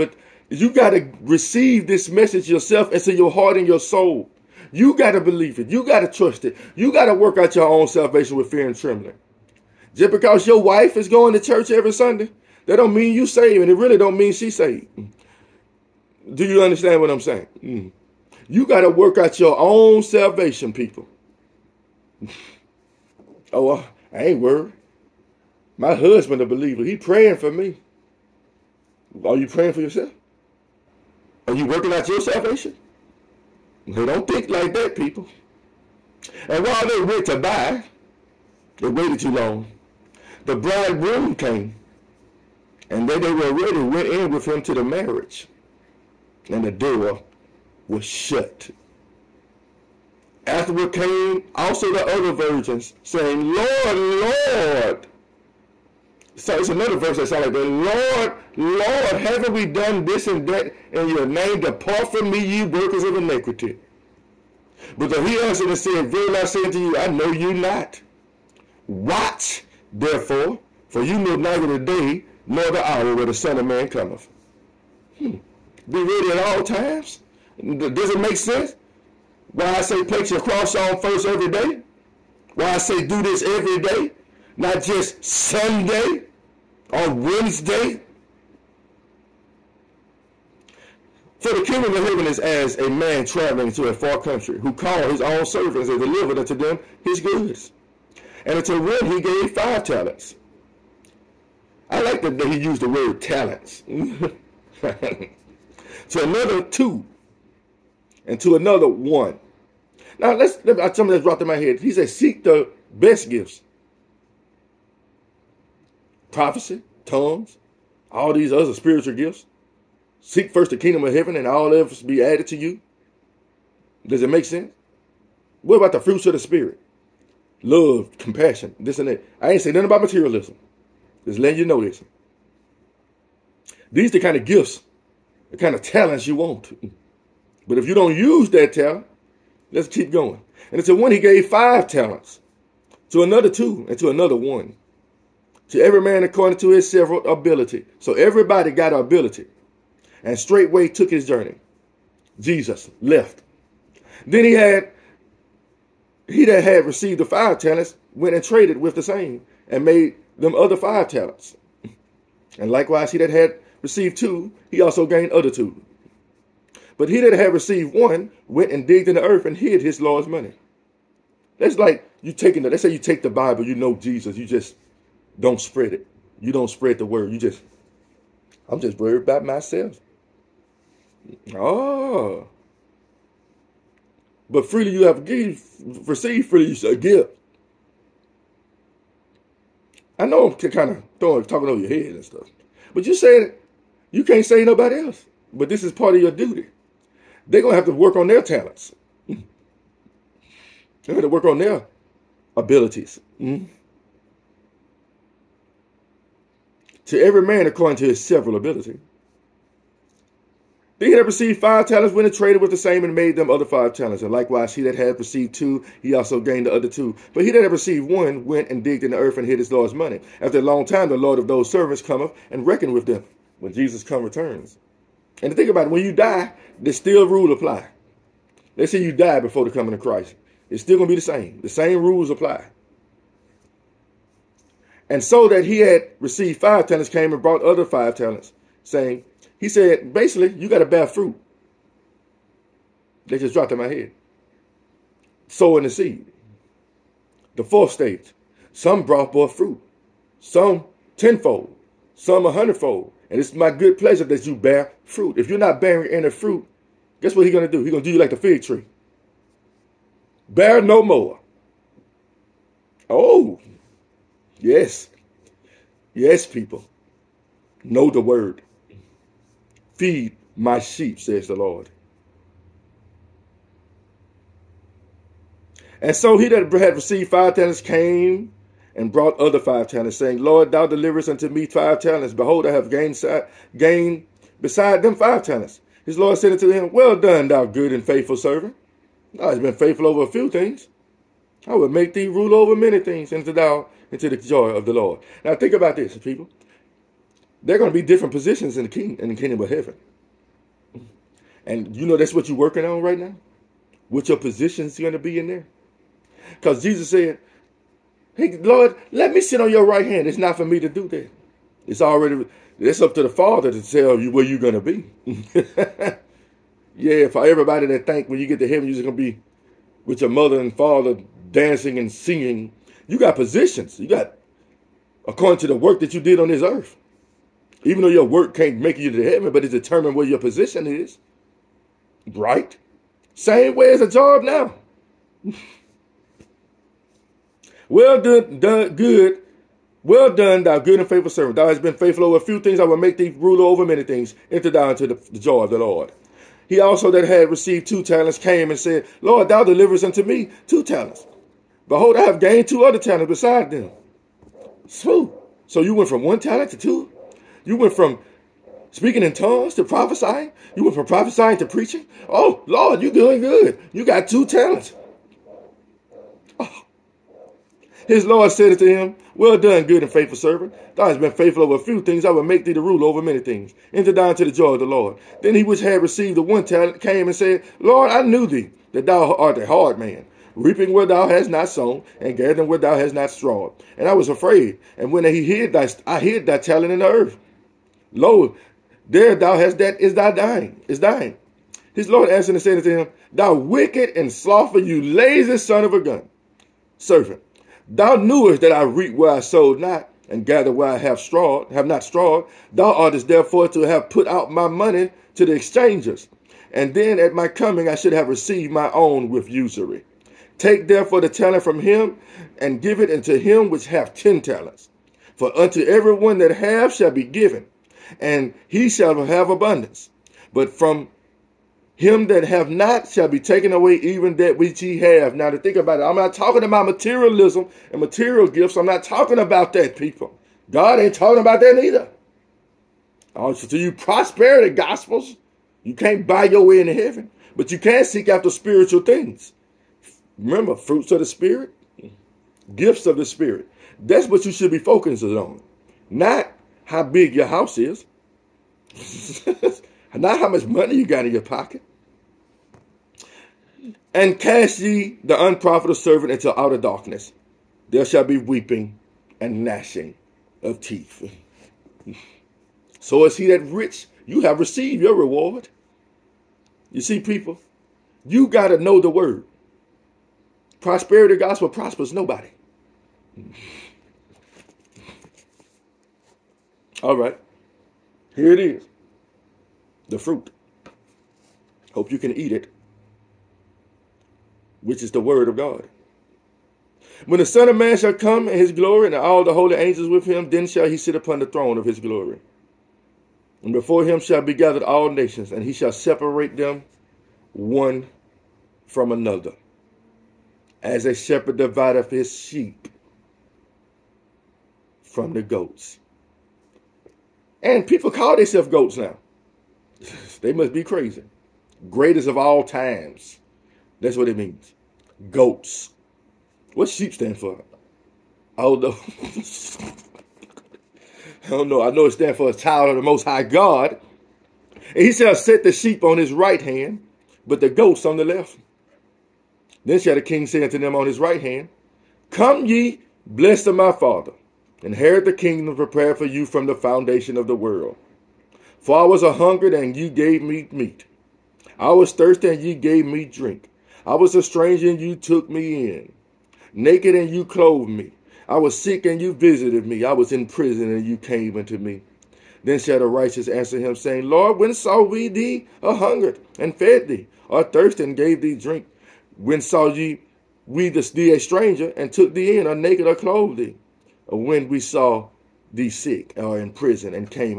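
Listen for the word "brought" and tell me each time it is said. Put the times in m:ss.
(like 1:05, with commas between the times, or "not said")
3:57, 4:09, 4:39.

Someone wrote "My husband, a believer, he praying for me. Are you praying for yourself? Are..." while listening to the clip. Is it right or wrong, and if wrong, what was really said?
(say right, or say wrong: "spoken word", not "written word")
right.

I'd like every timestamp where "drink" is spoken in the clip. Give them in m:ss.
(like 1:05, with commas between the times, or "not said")
9:03, 9:18.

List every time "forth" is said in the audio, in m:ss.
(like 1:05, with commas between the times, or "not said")
4:09.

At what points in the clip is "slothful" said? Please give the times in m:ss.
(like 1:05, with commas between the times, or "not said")
6:34.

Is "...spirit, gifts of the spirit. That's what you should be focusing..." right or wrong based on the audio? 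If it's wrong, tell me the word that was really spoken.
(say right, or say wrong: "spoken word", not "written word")
right.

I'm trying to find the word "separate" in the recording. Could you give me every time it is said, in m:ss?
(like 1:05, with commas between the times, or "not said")
8:15.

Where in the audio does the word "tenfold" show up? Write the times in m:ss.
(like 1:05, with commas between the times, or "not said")
4:11.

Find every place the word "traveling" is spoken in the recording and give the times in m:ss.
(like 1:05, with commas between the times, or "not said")
1:33.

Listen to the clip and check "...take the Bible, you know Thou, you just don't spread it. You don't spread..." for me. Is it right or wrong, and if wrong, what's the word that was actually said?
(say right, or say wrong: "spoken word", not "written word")
wrong: "Jesus", not "Thou".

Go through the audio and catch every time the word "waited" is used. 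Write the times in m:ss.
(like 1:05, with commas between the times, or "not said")
0:38.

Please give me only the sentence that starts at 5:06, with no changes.
Because Jesus said, Hey, Lord, let me sit on your right hand.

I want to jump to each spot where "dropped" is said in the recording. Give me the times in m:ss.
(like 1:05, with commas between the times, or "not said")
1:51, 4:03.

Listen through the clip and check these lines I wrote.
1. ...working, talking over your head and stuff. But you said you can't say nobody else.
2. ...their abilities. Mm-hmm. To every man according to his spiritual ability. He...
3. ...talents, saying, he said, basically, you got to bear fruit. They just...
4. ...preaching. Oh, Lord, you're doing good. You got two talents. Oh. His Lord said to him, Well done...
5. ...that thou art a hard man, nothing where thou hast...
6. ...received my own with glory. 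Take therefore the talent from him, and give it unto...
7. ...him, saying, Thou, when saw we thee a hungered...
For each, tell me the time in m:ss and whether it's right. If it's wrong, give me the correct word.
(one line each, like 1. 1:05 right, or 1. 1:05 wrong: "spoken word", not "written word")
1. 3:11 wrong: "throwing", not "working"
2. 3:21 wrong: "several", not "spiritual"
3. 3:58 right
4. 6:01 right
5. 6:18 wrong: "reaping", not "nothing"
6. 6:48 wrong: "usury", not "glory"
7. 9:13 wrong: "Lord", not "Thou".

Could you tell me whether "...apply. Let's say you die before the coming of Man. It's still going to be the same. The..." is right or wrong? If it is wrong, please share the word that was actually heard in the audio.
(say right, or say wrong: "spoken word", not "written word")
wrong: "Christ", not "Man".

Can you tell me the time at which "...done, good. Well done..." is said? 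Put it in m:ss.
5:38.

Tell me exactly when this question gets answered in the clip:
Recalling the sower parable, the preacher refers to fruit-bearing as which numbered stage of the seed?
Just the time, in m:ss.
4:07.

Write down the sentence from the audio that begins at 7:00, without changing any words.
But from him that have not shall be taken away even that which he have.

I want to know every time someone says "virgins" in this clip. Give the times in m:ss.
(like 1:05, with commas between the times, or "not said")
0:52.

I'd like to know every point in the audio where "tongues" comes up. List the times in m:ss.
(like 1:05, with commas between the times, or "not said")
1:57, 5:59.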